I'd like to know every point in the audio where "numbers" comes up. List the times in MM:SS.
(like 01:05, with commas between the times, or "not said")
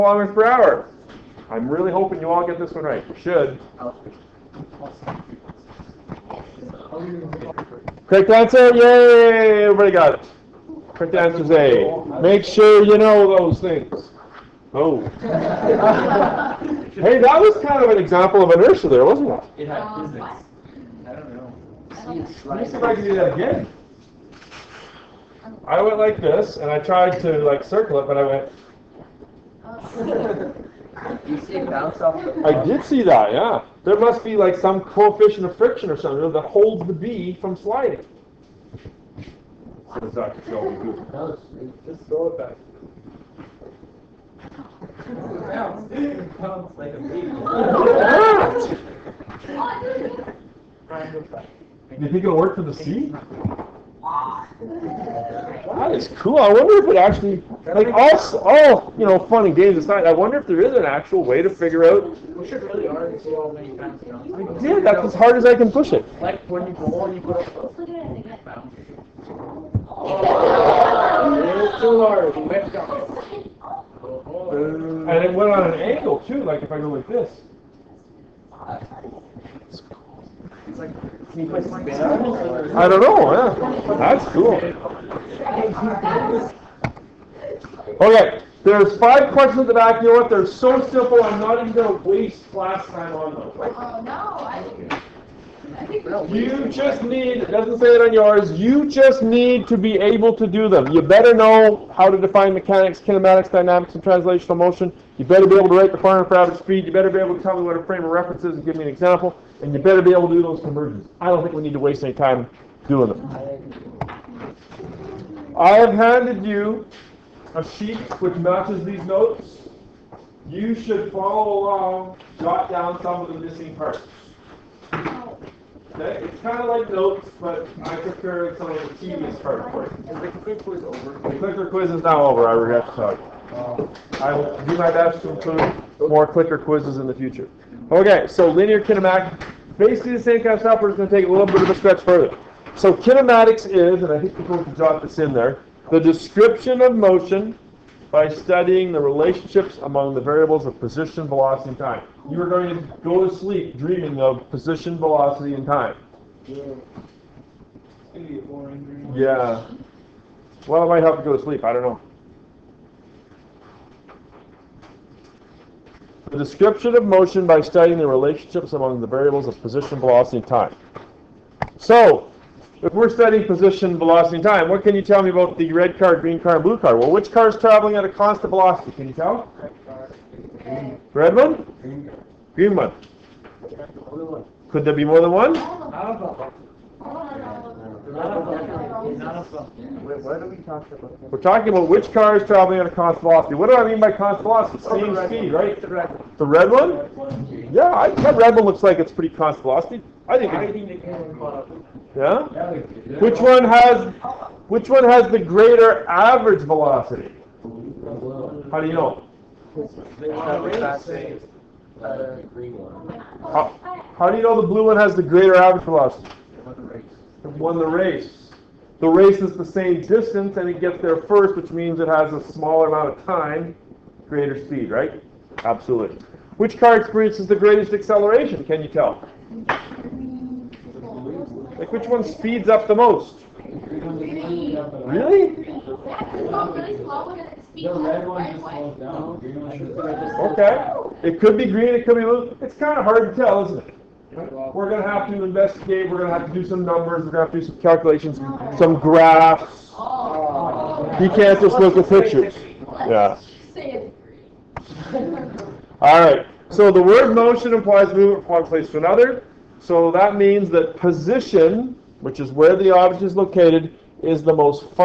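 04:06.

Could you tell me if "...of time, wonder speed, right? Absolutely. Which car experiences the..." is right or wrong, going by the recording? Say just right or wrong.
wrong.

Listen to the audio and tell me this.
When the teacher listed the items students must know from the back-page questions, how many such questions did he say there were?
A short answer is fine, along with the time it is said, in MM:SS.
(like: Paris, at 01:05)
5, at 01:28.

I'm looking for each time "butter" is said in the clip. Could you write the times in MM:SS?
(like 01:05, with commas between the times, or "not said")
not said.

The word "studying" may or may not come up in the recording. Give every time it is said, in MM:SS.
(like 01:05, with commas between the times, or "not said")
02:28, 02:47, 02:53.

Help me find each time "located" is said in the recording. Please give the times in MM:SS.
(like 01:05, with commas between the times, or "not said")
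04:23.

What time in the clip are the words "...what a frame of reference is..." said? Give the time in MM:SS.
01:47.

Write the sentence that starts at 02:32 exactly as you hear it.
You are going to go to sleep dreaming of position, velocity, and time.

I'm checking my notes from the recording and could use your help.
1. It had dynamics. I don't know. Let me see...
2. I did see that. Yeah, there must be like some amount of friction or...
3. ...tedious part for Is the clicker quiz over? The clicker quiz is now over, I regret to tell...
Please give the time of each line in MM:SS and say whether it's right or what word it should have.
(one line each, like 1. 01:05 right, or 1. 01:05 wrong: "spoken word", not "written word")
1. 00:19 wrong: "physics", not "dynamics"
2. 00:32 wrong: "coefficient", not "amount"
3. 02:09 right.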